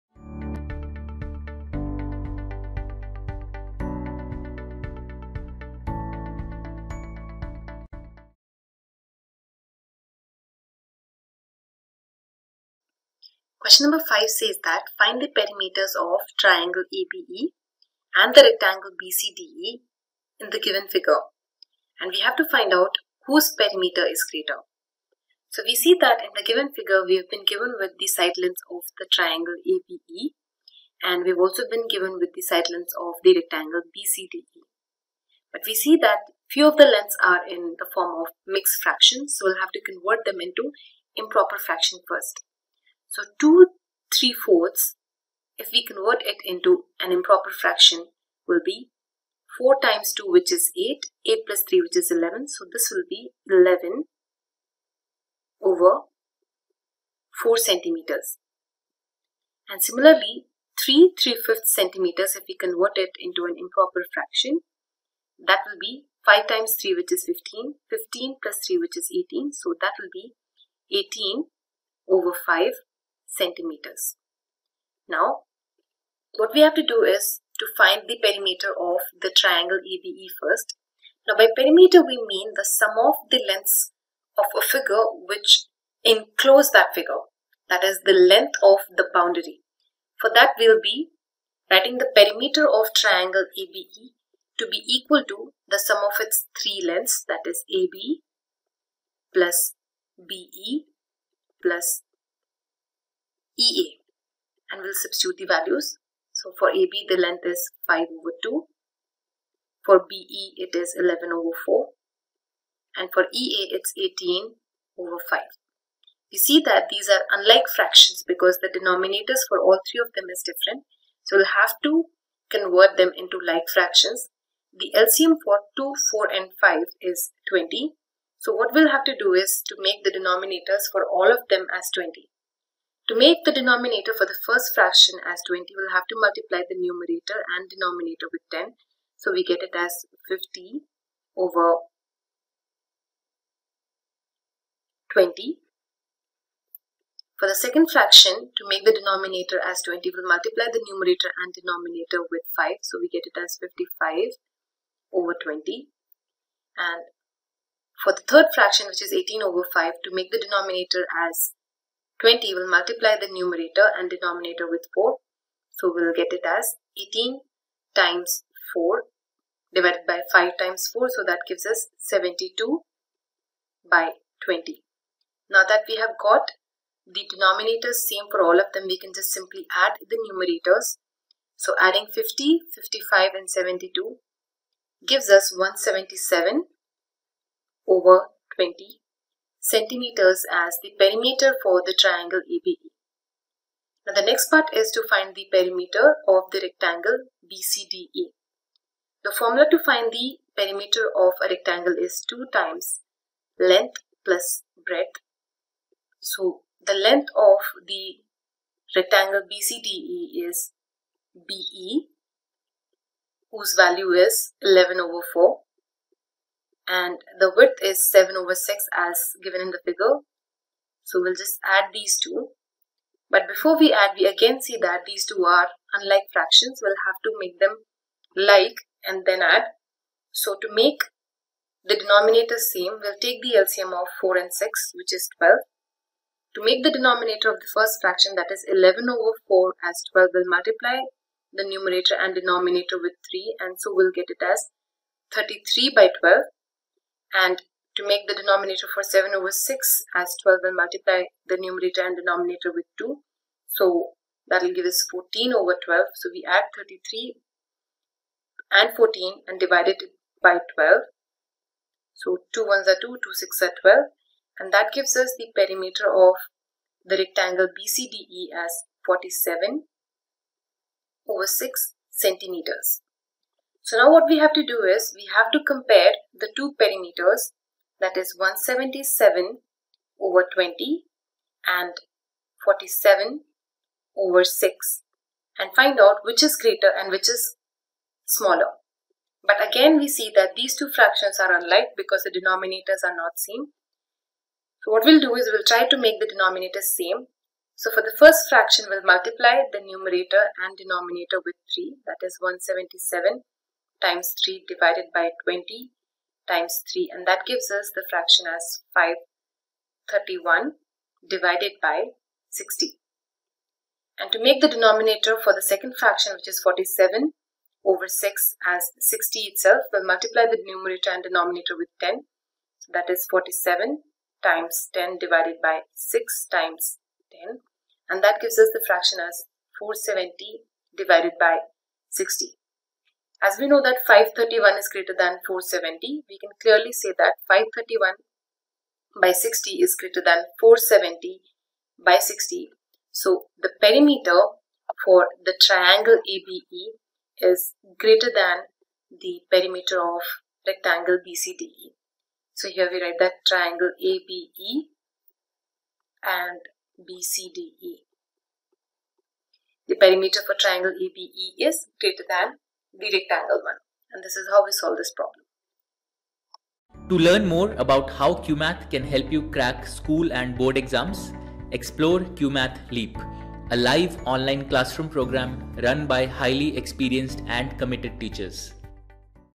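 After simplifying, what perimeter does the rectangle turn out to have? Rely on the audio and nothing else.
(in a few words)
47/6 cm.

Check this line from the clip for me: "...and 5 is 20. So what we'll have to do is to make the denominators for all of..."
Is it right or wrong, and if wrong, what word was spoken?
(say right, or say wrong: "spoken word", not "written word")
right.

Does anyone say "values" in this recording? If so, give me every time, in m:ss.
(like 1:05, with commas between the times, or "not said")
1:45, 3:33.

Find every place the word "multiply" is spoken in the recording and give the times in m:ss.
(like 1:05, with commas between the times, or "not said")
2:16, 2:30, 2:42, 4:00, 4:10, 4:59, 5:20.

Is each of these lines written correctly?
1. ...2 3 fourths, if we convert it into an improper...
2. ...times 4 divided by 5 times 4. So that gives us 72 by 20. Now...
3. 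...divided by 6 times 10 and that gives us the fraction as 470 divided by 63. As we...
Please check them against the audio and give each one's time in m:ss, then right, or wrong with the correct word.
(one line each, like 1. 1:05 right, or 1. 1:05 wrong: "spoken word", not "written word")
1. 0:43 right
2. 2:47 right
3. 5:25 wrong: "60", not "63".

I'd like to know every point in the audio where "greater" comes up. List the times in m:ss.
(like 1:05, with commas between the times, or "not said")
0:24, 4:46, 5:34, 5:39, 5:47, 6:01.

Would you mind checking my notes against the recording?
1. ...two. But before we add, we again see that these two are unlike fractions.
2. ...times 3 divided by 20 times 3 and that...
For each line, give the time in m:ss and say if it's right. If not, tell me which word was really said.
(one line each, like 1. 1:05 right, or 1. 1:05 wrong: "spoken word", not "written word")
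1. 3:42 right
2. 5:04 right.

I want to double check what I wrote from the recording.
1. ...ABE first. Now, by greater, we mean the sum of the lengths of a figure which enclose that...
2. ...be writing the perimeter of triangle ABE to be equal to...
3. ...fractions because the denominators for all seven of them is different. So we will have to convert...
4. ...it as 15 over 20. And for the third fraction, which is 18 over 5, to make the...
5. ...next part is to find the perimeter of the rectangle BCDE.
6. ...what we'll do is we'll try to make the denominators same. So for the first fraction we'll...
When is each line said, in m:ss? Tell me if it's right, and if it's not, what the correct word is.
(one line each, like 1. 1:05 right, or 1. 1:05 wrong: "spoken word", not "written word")
1. 1:19 wrong: "perimeter", not "greater"
2. 1:30 right
3. 1:57 wrong: "three", not "seven"
4. 2:33 wrong: "55", not "15"
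5. 3:14 right
6. 4:54 right.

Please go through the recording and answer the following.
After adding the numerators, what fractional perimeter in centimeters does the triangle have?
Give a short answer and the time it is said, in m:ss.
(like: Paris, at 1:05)
177/20 cm, at 3:05.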